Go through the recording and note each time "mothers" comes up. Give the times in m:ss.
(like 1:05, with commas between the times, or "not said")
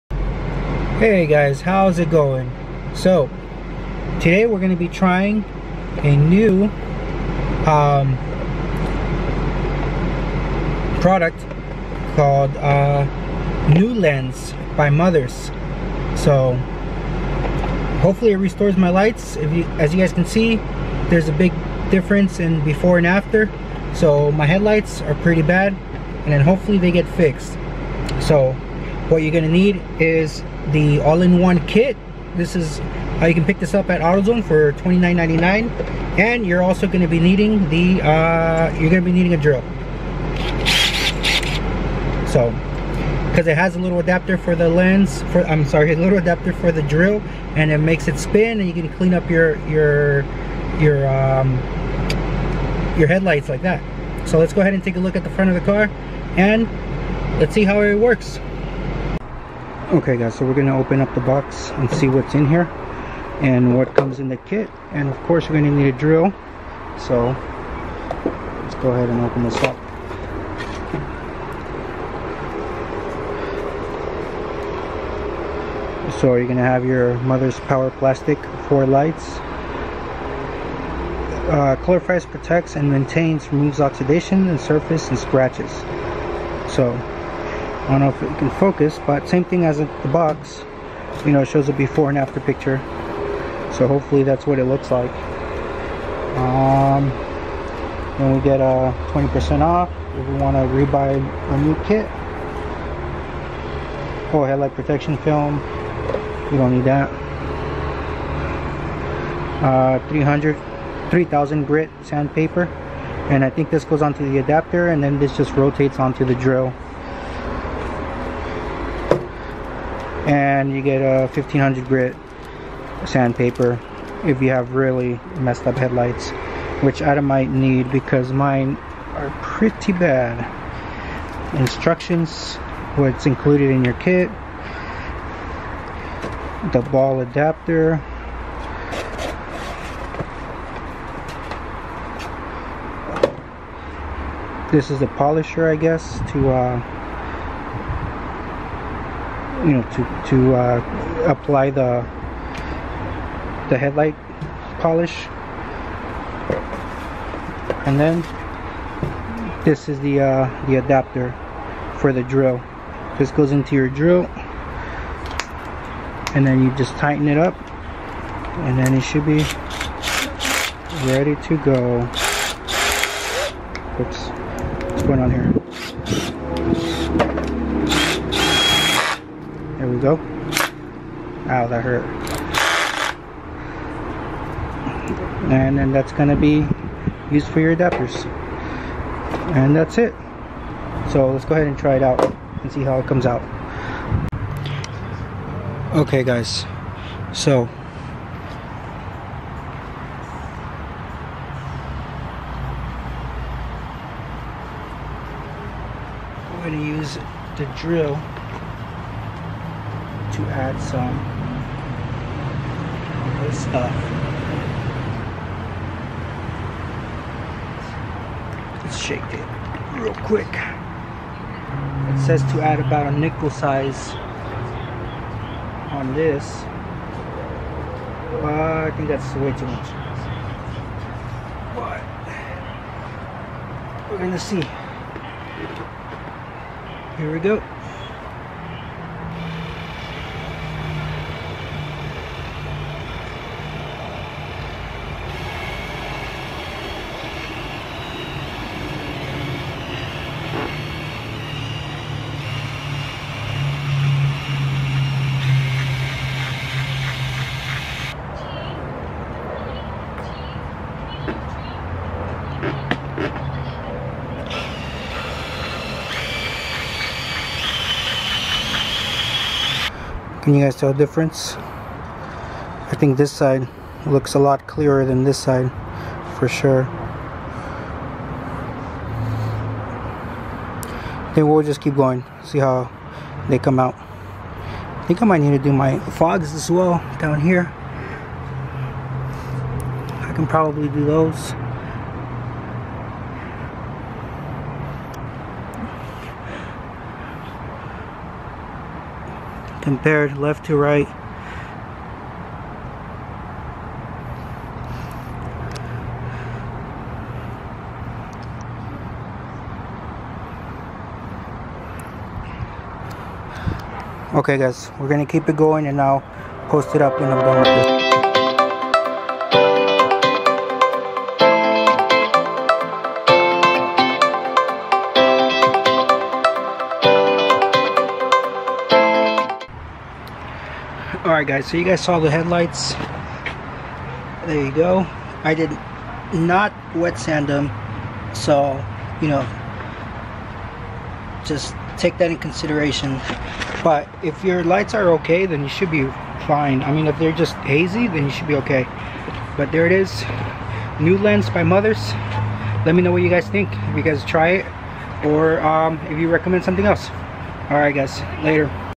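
0:14, 1:17, 5:51.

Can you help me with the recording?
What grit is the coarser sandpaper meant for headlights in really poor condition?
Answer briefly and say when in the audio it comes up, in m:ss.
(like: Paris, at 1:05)
1500, at 2:01.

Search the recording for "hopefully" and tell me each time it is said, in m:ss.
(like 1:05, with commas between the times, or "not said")
0:18, 0:26, 1:33.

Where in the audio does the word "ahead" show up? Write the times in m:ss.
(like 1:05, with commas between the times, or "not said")
0:54, 1:08, 3:11.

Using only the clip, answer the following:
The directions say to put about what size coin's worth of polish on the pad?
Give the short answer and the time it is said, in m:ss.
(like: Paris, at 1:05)
Nickel, at 3:43.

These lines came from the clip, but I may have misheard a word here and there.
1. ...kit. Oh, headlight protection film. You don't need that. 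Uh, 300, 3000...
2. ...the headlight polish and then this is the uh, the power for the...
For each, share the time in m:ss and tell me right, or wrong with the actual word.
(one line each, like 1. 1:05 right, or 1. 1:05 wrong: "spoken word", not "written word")
1. 1:41 right
2. 2:33 wrong: "adapter", not "power".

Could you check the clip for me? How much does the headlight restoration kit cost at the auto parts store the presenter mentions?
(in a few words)
$29.99.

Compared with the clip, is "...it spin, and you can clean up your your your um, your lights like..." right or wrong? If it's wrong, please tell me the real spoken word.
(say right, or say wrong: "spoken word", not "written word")
wrong: "headlights", not "lights".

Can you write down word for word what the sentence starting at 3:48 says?
Uh, I think that's way too much.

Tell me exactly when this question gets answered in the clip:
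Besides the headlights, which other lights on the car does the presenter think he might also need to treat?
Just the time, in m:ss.
4:46.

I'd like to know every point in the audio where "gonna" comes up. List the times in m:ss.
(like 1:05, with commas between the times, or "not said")
0:29, 1:00, 1:05, 1:16, 3:54, 5:15.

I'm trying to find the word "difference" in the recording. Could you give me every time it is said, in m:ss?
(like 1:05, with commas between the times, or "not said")
0:21, 4:30.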